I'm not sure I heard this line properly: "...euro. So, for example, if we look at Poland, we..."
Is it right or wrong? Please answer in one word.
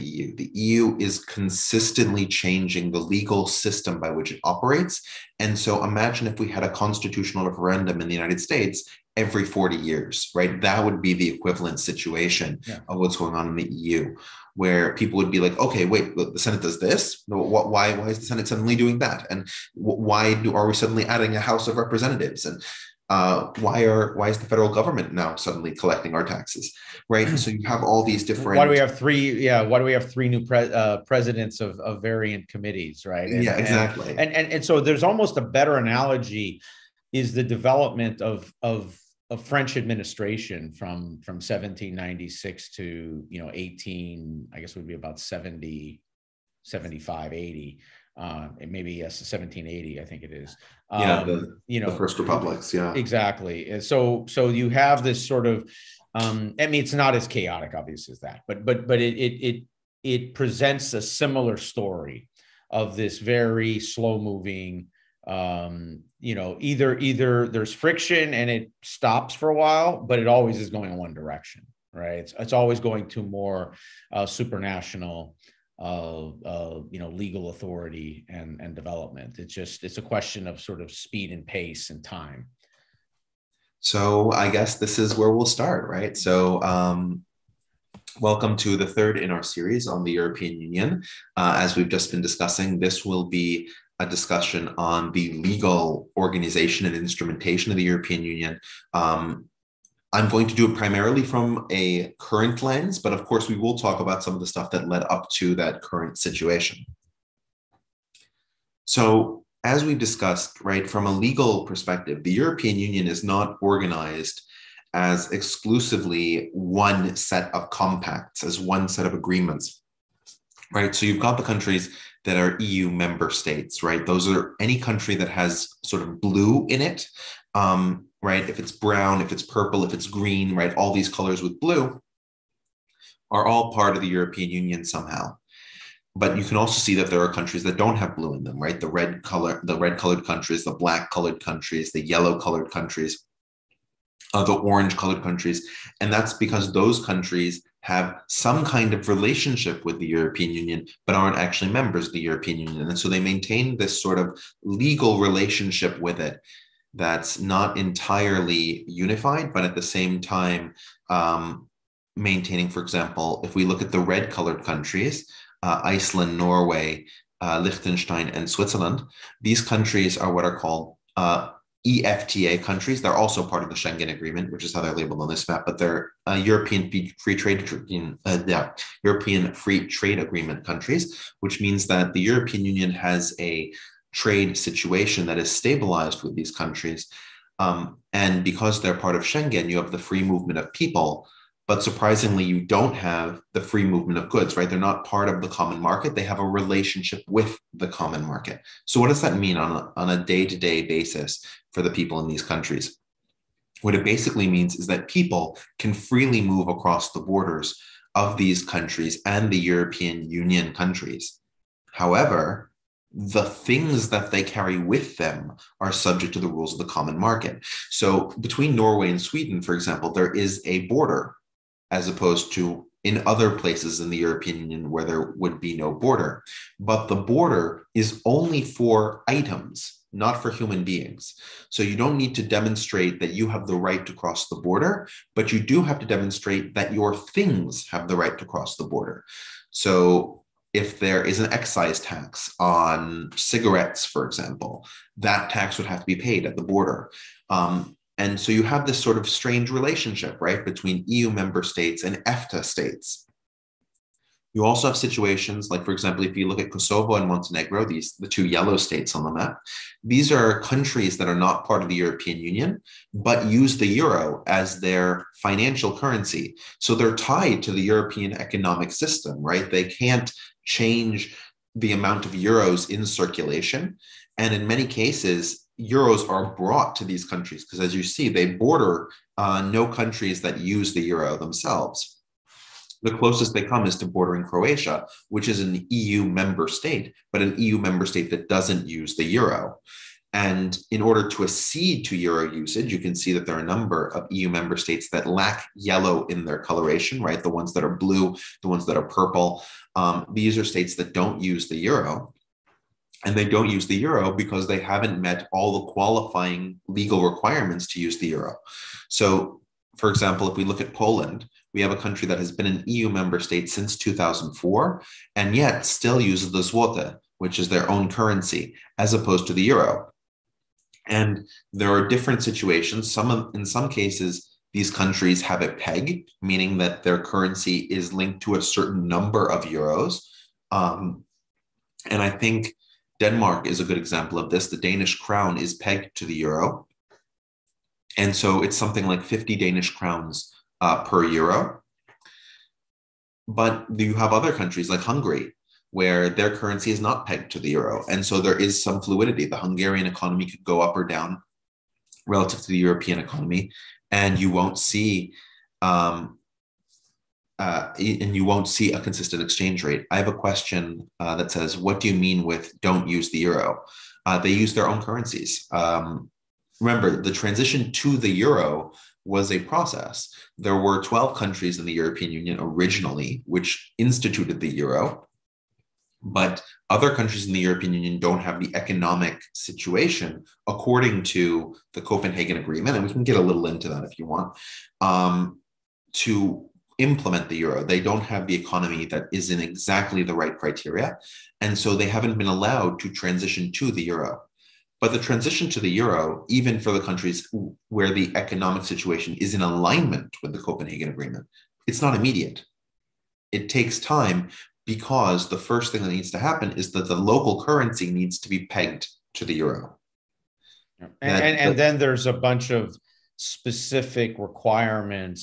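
right.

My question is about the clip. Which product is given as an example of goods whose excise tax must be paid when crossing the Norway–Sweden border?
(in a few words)
cigarettes.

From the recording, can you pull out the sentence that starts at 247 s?
Um, and so you have this sort of strange relationship, right, between EU member states and EFTA states.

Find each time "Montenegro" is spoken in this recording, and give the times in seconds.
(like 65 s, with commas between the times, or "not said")
257 s.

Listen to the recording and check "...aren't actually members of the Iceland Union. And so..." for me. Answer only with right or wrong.
wrong.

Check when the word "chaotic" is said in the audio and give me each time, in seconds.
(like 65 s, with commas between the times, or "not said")
57 s.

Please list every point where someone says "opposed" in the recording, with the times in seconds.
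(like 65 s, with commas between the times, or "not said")
222 s, 319 s.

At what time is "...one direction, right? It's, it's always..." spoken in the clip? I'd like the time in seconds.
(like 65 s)
70 s.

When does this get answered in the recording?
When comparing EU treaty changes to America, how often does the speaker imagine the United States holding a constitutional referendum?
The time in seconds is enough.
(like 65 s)
9 s.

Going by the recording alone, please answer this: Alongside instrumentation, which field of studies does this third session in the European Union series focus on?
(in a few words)
legal organization.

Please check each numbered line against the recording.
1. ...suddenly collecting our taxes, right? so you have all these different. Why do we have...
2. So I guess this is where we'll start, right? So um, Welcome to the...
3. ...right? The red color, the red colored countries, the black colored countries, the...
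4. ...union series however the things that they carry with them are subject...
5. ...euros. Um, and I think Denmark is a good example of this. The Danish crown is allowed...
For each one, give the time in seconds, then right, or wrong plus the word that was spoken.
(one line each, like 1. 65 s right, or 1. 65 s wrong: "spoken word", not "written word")
1. 25 s right
2. 83 s right
3. 138 s right
4. 210 s wrong: "countries", not "series"
5. 329 s wrong: "pegged", not "allowed".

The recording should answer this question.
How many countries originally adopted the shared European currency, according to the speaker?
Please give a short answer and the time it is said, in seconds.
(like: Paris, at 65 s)
12, at 371 s.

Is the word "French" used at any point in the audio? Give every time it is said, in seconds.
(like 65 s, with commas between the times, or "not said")
39 s.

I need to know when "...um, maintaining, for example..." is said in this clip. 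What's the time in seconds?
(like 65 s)
161 s.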